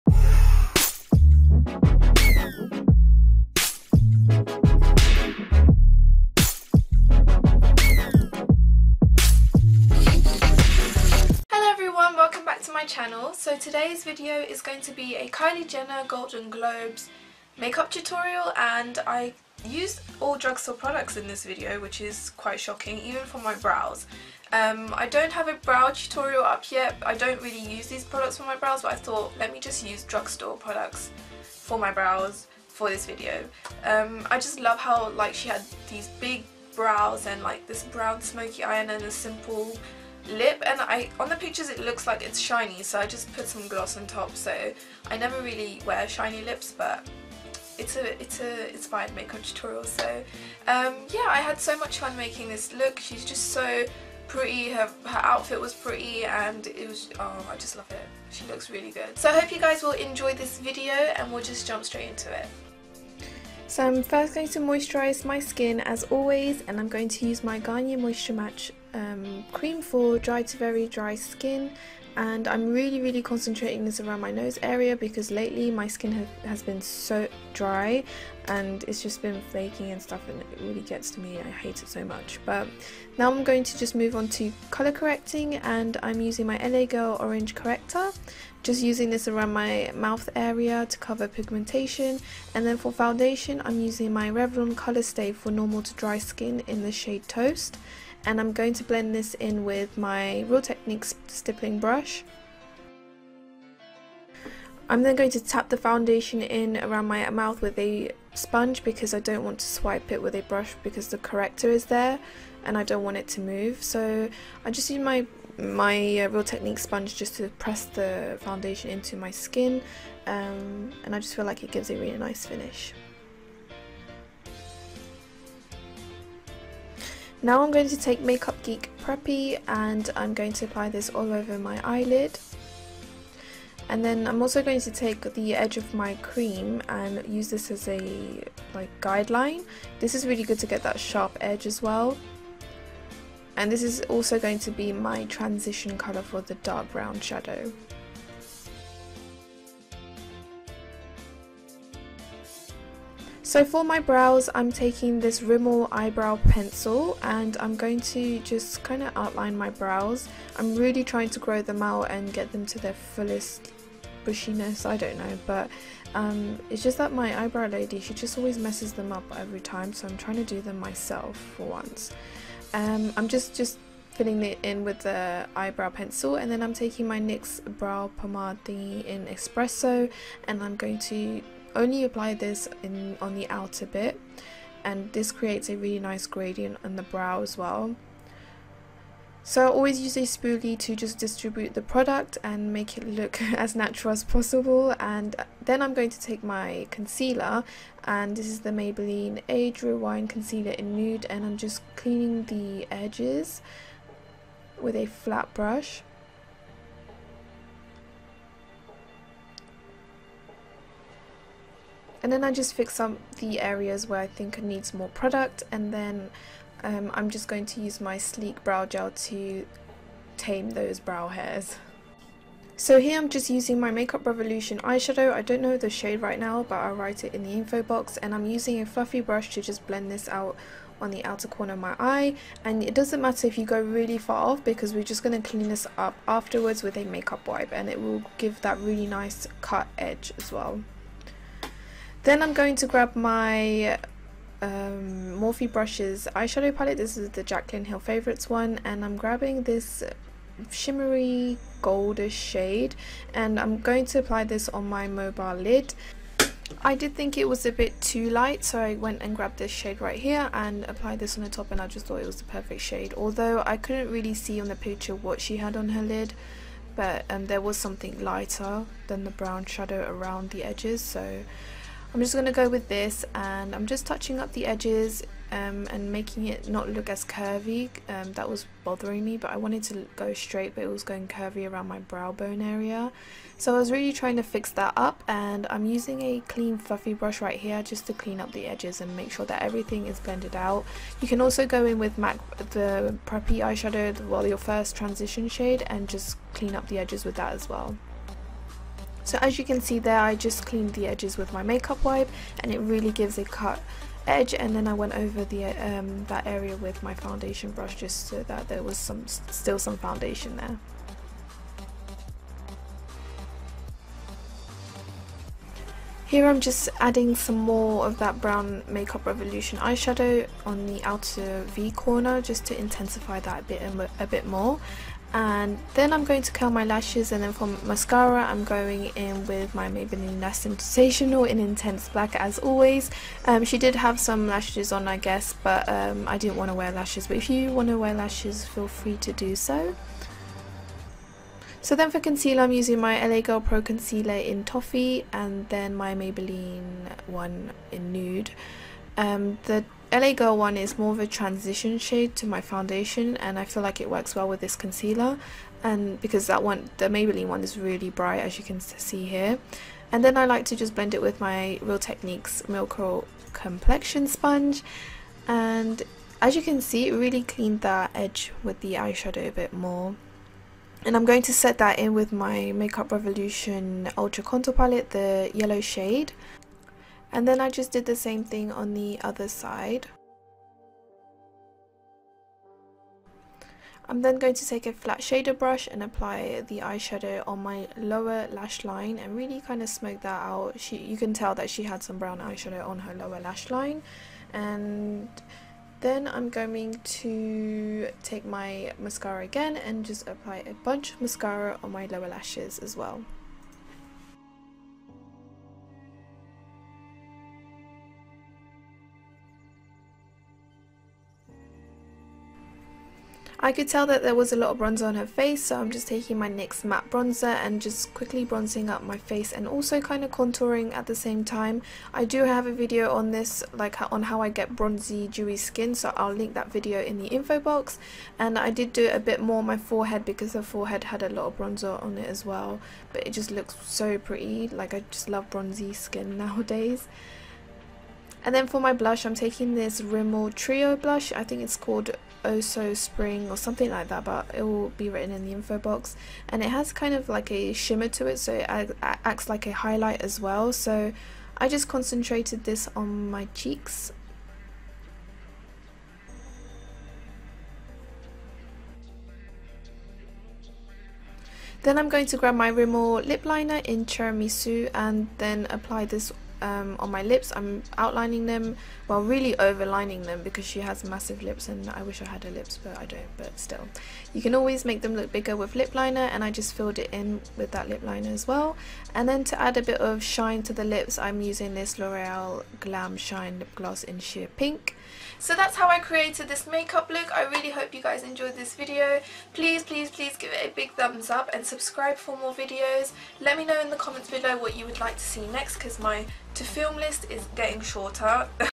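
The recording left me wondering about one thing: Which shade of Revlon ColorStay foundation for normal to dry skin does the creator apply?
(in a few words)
Toast.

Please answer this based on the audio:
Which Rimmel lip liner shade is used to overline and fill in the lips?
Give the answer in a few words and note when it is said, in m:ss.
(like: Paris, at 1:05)
Tiramisu, at 7:44.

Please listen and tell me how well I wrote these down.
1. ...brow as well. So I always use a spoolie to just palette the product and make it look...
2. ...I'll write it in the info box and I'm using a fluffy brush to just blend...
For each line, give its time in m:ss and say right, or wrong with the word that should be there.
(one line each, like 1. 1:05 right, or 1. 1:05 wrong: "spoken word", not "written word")
1. 3:07 wrong: "distribute", not "palette"
2. 3:46 right.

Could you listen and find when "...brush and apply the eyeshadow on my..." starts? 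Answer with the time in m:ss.
6:25.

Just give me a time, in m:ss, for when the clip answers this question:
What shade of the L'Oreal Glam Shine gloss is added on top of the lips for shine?
8:04.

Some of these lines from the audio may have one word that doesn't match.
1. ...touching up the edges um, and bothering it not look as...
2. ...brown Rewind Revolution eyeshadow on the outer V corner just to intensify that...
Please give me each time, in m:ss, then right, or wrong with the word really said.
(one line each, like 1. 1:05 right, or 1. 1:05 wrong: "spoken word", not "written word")
1. 4:34 wrong: "making", not "bothering"
2. 5:18 wrong: "Makeup", not "Rewind".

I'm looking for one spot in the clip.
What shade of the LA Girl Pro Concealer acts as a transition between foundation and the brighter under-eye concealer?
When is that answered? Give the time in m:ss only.
5:44.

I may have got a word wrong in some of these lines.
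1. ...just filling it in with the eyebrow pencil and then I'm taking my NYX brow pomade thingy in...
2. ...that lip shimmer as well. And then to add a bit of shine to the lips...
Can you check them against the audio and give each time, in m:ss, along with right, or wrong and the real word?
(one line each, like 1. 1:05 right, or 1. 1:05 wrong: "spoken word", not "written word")
1. 2:53 right
2. 7:57 wrong: "liner", not "shimmer".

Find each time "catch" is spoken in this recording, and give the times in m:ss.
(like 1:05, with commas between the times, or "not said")
not said.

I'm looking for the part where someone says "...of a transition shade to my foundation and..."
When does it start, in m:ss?
5:51.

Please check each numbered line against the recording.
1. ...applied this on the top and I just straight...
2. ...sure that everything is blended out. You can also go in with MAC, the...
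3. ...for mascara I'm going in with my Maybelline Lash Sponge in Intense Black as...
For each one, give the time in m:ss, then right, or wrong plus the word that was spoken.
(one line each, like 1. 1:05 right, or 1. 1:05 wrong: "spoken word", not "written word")
1. 4:20 wrong: "thought", not "straight"
2. 4:49 right
3. 5:27 wrong: "Sensational", not "Sponge".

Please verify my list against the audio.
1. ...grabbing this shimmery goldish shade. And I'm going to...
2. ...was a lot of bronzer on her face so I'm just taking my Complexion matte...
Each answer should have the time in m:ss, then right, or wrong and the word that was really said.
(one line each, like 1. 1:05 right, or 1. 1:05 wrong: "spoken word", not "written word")
1. 4:09 right
2. 6:54 wrong: "NYX", not "Complexion".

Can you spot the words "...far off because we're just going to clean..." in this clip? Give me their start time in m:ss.
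3:54.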